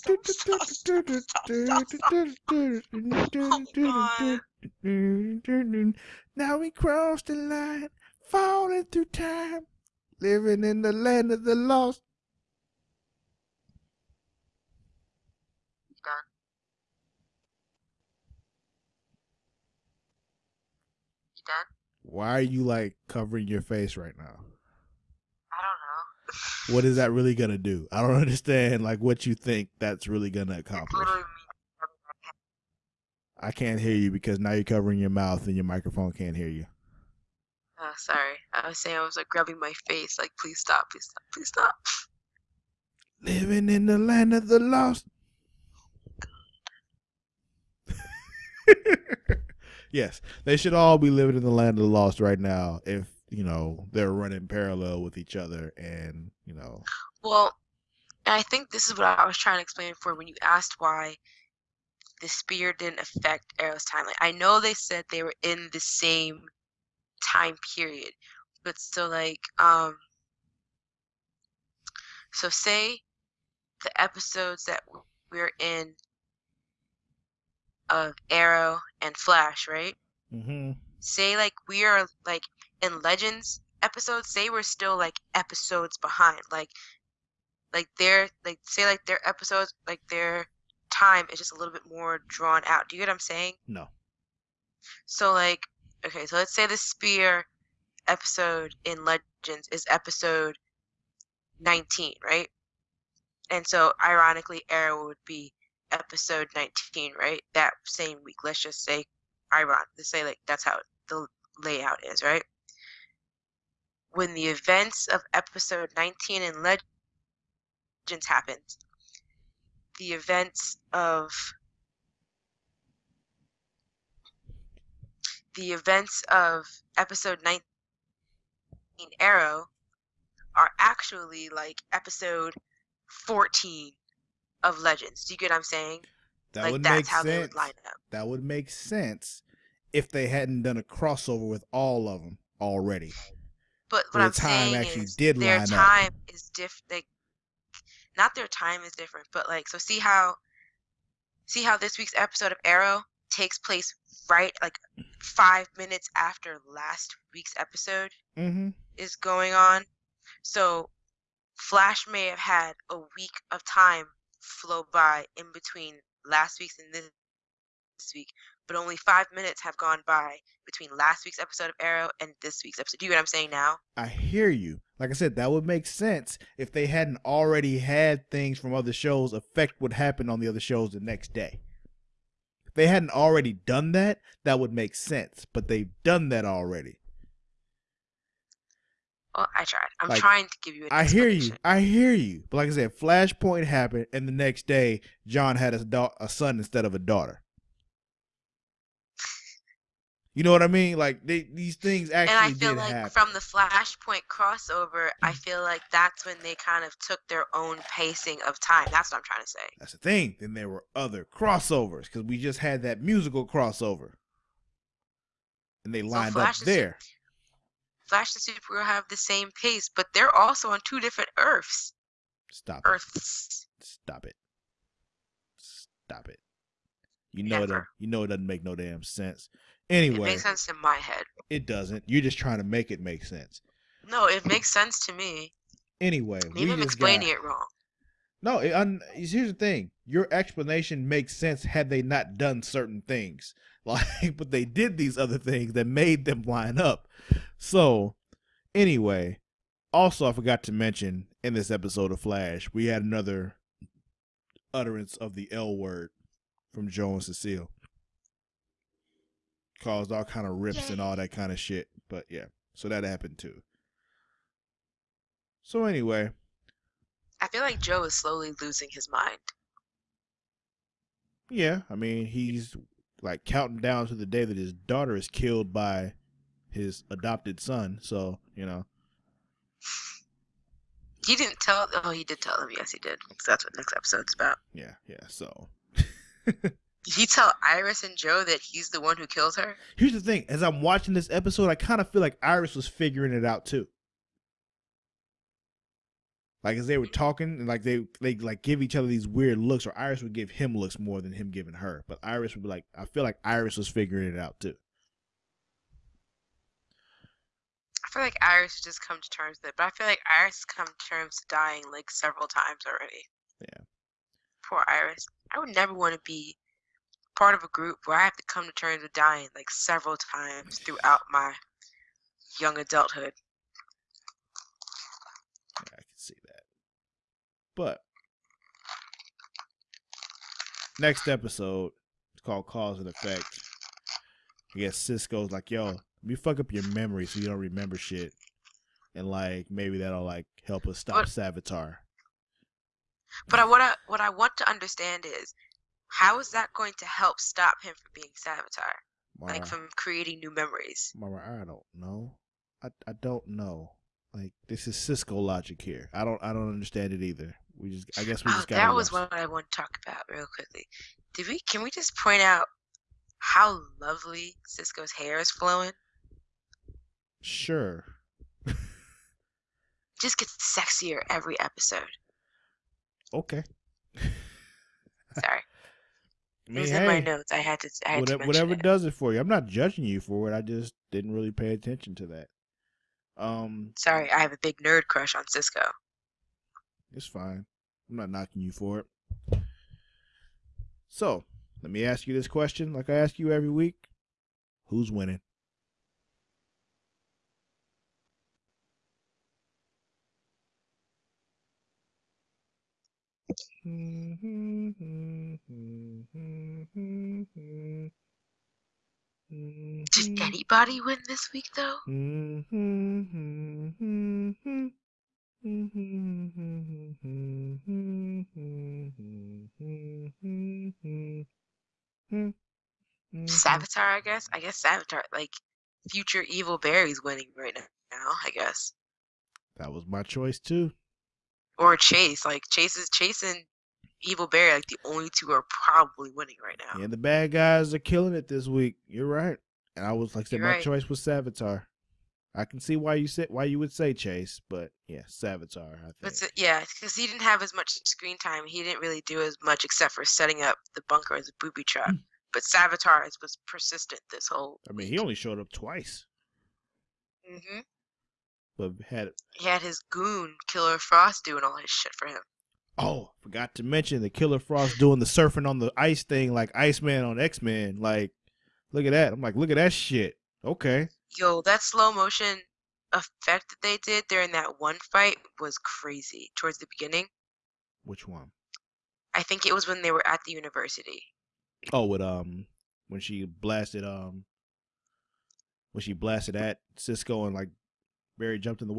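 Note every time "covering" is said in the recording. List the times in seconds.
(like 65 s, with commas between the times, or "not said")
23 s, 34 s.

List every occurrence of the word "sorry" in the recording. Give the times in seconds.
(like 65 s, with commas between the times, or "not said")
37 s, 375 s, 383 s.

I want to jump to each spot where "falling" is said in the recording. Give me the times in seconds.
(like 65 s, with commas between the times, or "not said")
8 s.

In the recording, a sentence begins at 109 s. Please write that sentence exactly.
Let's say like that's how the layout is, right?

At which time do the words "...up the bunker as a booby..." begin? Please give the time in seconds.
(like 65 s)
450 s.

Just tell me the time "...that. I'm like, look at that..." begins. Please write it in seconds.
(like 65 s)
469 s.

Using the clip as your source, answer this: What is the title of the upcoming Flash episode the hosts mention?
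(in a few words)
Cause and Effect.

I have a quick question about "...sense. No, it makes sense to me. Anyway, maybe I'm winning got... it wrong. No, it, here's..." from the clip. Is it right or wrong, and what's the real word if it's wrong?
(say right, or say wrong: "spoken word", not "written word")
wrong: "explaining", not "winning".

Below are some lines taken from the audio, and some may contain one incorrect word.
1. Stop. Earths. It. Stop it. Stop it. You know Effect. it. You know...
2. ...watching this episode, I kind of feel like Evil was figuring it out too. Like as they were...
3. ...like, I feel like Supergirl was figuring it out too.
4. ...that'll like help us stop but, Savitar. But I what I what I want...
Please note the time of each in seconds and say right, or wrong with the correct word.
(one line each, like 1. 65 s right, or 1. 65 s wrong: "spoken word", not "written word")
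1. 222 s wrong: "Never", not "Effect"
2. 290 s wrong: "Iris", not "Evil"
3. 302 s wrong: "Iris", not "Supergirl"
4. 339 s right.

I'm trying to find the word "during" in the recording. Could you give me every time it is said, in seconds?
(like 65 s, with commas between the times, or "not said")
474 s.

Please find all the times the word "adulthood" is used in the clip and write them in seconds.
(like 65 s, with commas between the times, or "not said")
322 s.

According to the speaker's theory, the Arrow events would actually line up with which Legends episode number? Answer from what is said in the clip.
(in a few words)
14.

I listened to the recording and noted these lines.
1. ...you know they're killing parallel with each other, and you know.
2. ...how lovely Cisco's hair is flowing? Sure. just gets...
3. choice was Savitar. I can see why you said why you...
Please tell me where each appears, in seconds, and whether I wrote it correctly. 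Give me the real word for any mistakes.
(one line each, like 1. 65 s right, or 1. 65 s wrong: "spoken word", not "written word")
1. 53 s wrong: "running", not "killing"
2. 363 s right
3. 440 s right.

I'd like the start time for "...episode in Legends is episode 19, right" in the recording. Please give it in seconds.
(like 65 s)
98 s.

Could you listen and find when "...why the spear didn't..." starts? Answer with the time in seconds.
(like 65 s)
60 s.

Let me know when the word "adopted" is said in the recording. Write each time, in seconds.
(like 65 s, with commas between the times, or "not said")
277 s.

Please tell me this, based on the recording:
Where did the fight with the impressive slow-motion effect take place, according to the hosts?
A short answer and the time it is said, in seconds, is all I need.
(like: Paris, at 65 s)
the university, at 480 s.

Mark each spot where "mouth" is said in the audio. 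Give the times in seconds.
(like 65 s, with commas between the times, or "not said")
35 s.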